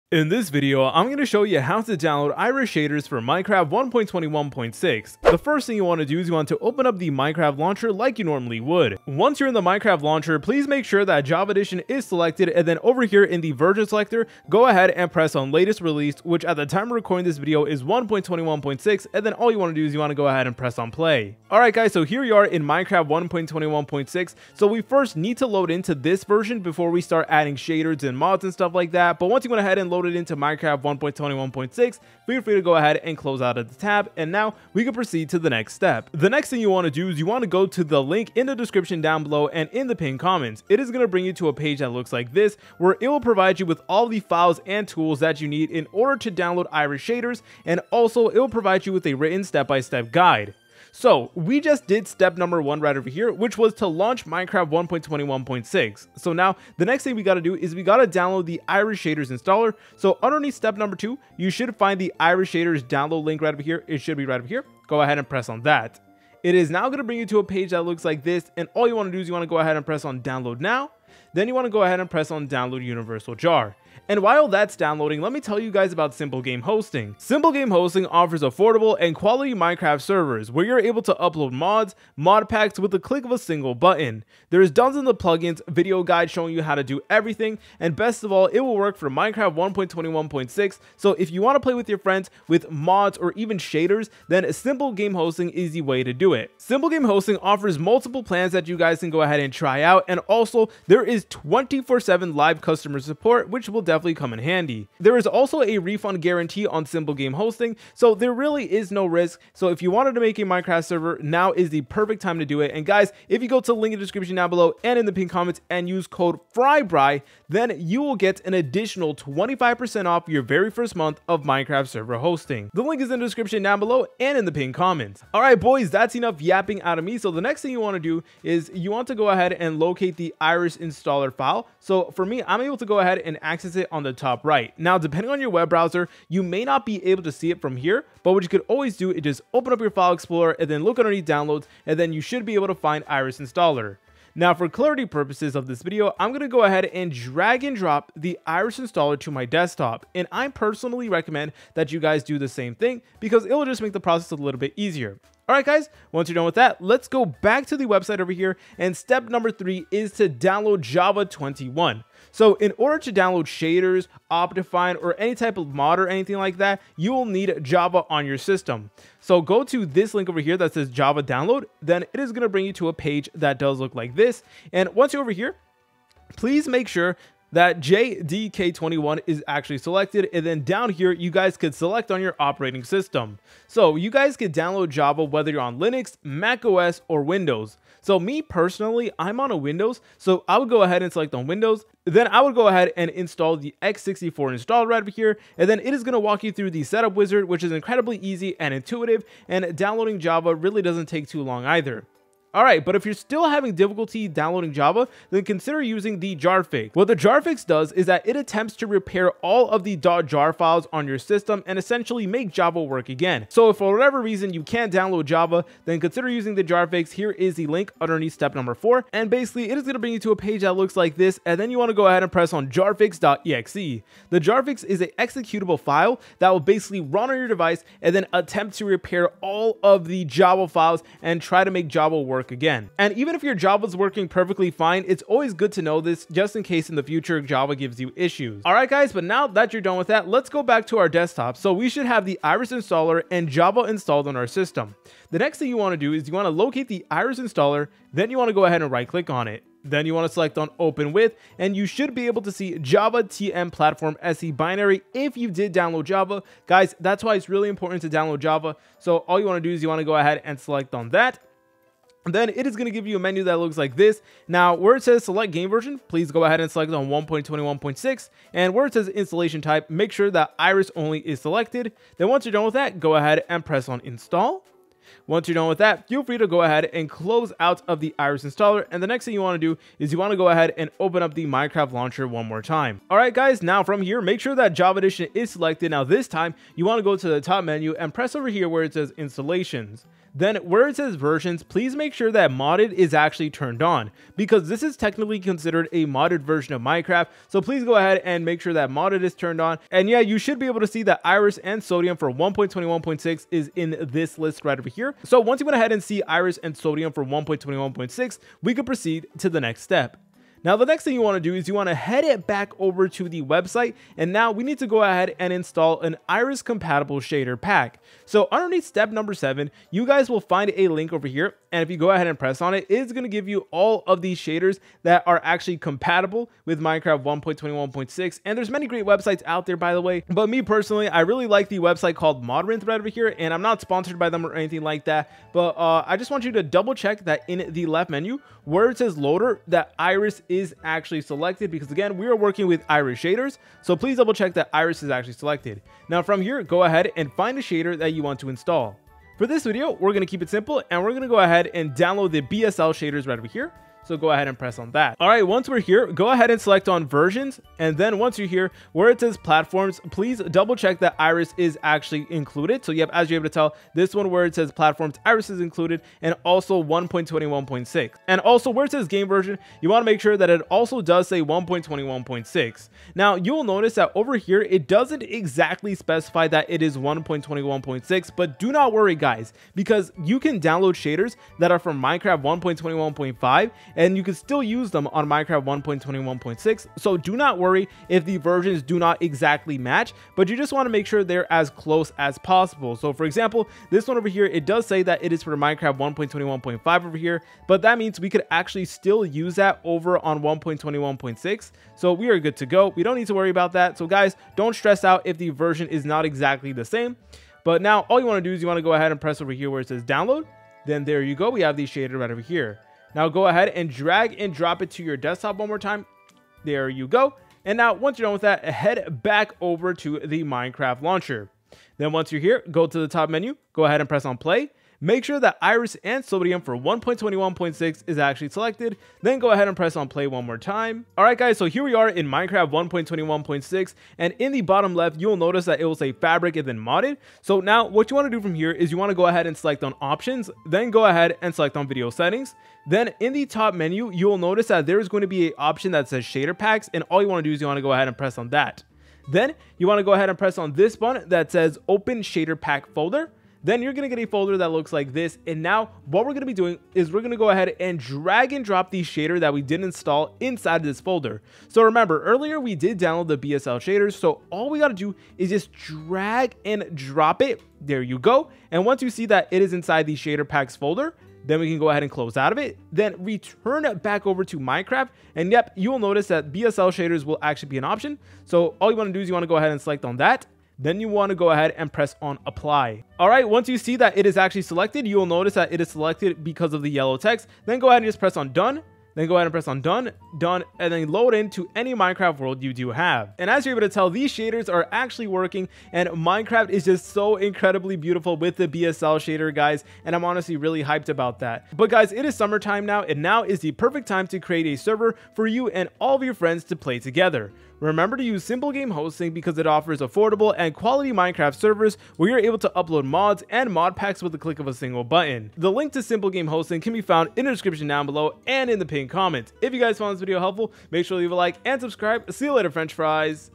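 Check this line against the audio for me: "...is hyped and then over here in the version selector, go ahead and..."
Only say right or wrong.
wrong.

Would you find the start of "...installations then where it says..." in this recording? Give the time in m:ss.
4:49.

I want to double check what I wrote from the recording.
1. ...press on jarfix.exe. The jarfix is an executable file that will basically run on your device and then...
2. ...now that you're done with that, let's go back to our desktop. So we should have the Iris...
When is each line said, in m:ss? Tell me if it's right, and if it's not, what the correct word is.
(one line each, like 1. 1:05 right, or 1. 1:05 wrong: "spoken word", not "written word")
1. 3:42 right
2. 3:59 right.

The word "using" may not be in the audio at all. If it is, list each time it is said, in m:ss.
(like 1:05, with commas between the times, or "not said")
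3:25, 3:36.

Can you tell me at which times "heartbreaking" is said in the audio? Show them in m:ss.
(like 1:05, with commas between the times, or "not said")
not said.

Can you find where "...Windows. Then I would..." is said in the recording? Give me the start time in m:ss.
3:11.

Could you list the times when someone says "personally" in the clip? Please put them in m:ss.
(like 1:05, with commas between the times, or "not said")
2:30, 3:08, 5:30.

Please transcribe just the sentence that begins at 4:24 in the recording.
Now, where it says select game version, please go ahead and select on 1.21.6.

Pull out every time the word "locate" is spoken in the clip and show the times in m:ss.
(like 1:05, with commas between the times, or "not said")
2:09, 4:06.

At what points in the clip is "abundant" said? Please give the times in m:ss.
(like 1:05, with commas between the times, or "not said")
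not said.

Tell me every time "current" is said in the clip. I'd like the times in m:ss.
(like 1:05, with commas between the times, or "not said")
not said.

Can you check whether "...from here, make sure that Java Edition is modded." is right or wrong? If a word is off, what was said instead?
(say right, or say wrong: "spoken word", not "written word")
wrong: "selected", not "modded".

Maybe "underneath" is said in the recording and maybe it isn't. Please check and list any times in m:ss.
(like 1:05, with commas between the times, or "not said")
1:00, 2:20, 3:38, 5:18.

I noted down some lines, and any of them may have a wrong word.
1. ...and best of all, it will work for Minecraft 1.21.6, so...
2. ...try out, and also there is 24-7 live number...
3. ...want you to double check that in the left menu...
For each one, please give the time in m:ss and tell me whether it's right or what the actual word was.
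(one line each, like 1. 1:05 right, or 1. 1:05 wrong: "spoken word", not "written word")
1. 1:27 right
2. 1:39 wrong: "customer", not "number"
3. 5:36 right.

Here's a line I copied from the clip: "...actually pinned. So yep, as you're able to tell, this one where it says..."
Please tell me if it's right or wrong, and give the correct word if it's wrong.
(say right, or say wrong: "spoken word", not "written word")
wrong: "included", not "pinned".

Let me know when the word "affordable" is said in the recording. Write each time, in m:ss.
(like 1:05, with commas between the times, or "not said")
1:18, 8:30.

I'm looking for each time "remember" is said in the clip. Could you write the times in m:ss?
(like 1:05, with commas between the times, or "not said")
7:41, 8:27.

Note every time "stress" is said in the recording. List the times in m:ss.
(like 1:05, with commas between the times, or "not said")
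6:44.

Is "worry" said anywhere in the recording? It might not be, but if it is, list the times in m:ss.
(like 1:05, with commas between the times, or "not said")
6:18, 6:27, 6:43.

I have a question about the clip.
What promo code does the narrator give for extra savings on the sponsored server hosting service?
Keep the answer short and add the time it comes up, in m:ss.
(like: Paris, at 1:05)
FRYBRY, at 1:56.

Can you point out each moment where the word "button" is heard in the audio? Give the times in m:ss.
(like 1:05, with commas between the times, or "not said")
1:23, 7:30, 8:35.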